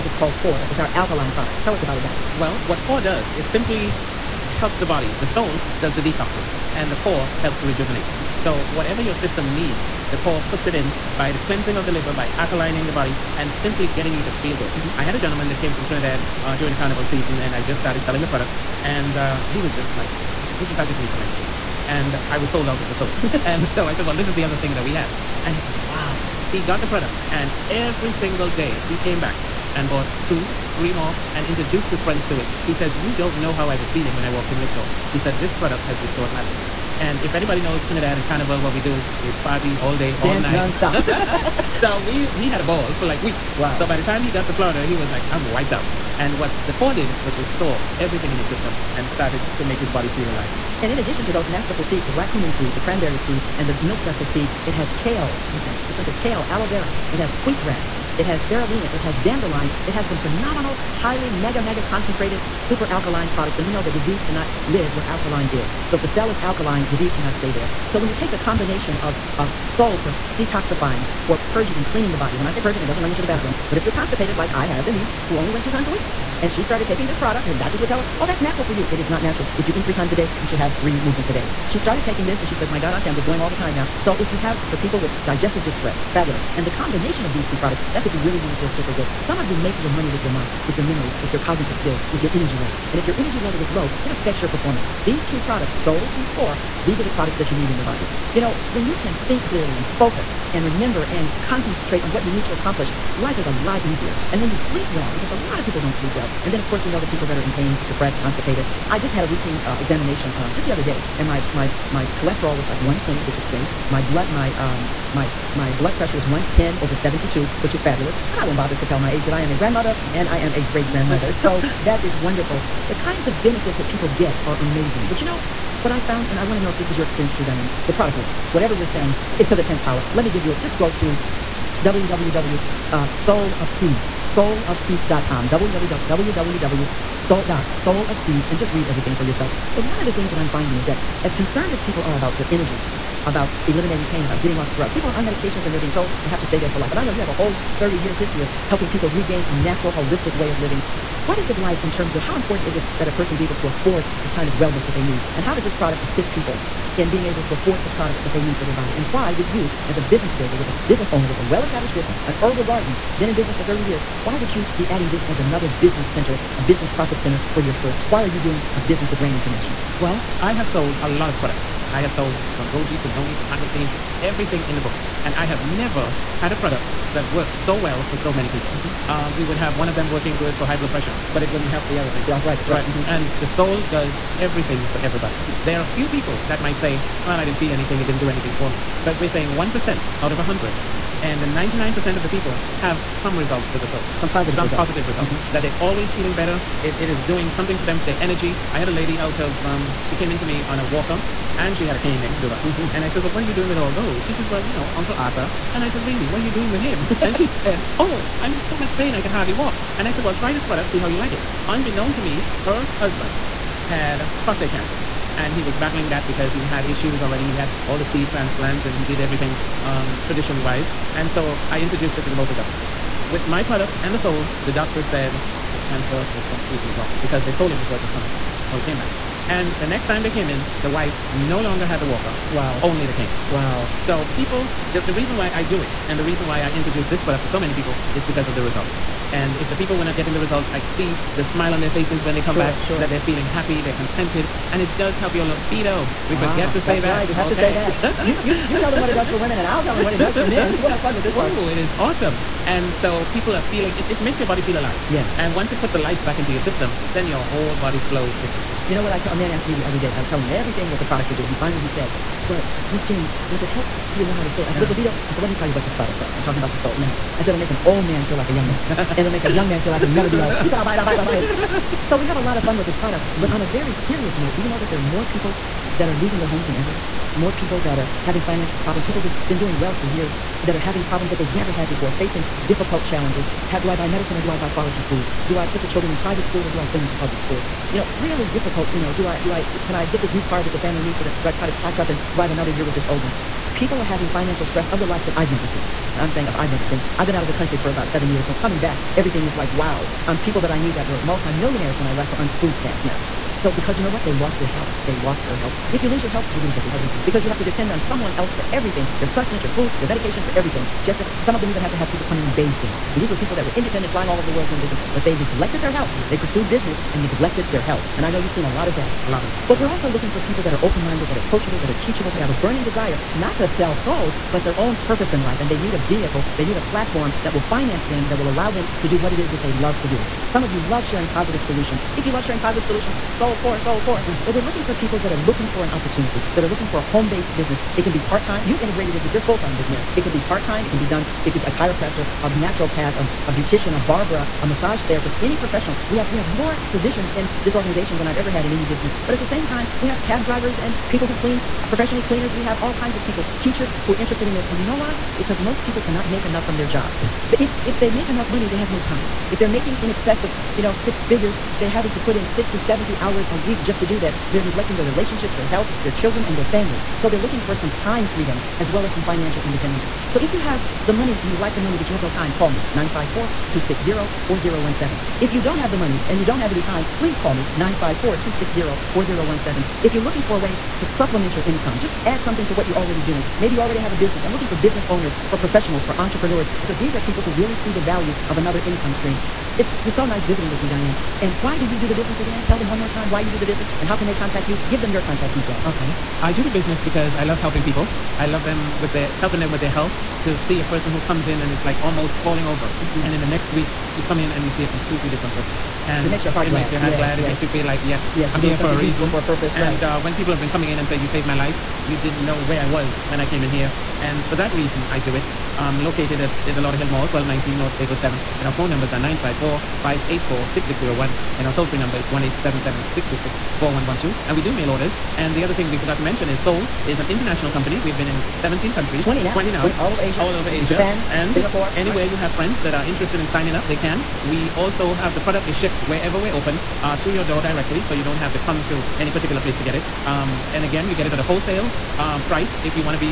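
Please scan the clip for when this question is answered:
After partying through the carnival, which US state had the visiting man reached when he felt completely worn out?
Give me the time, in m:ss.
0:44.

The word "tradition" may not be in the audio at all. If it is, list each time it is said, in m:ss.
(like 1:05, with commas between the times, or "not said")
3:40.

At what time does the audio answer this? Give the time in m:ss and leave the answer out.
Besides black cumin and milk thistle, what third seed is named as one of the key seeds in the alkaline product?
0:52.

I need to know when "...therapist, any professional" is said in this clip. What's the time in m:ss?
5:45.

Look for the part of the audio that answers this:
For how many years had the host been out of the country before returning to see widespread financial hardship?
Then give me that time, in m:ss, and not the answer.
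4:58.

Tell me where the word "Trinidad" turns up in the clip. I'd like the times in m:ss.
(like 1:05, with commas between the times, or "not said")
0:15, 0:37.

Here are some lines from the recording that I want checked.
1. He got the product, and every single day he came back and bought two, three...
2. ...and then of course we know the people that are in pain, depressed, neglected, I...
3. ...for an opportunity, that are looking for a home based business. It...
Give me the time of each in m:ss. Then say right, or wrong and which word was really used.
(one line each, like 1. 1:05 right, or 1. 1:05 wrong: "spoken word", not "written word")
1. 0:26 right
2. 1:46 wrong: "constipated", not "neglected"
3. 5:35 right.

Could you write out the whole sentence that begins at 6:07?
So they're looking for some time freedom as well as some financial independence.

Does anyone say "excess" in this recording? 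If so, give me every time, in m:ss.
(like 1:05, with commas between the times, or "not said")
6:00.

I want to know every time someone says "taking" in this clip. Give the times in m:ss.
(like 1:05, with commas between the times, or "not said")
1:16, 1:22.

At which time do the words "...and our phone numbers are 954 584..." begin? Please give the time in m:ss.
6:58.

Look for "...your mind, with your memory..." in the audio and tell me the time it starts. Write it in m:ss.
1:30.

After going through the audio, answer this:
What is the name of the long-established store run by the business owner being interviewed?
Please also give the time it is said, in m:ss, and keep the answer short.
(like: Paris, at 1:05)
Herbal Gardens, at 2:42.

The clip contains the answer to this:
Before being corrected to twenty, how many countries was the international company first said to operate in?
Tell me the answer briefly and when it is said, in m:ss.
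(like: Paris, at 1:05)
17, at 7:08.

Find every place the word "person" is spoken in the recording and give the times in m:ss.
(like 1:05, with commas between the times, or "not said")
2:33, 6:40, 6:45.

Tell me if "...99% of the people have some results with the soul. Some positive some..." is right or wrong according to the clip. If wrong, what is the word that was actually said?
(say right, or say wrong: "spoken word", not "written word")
right.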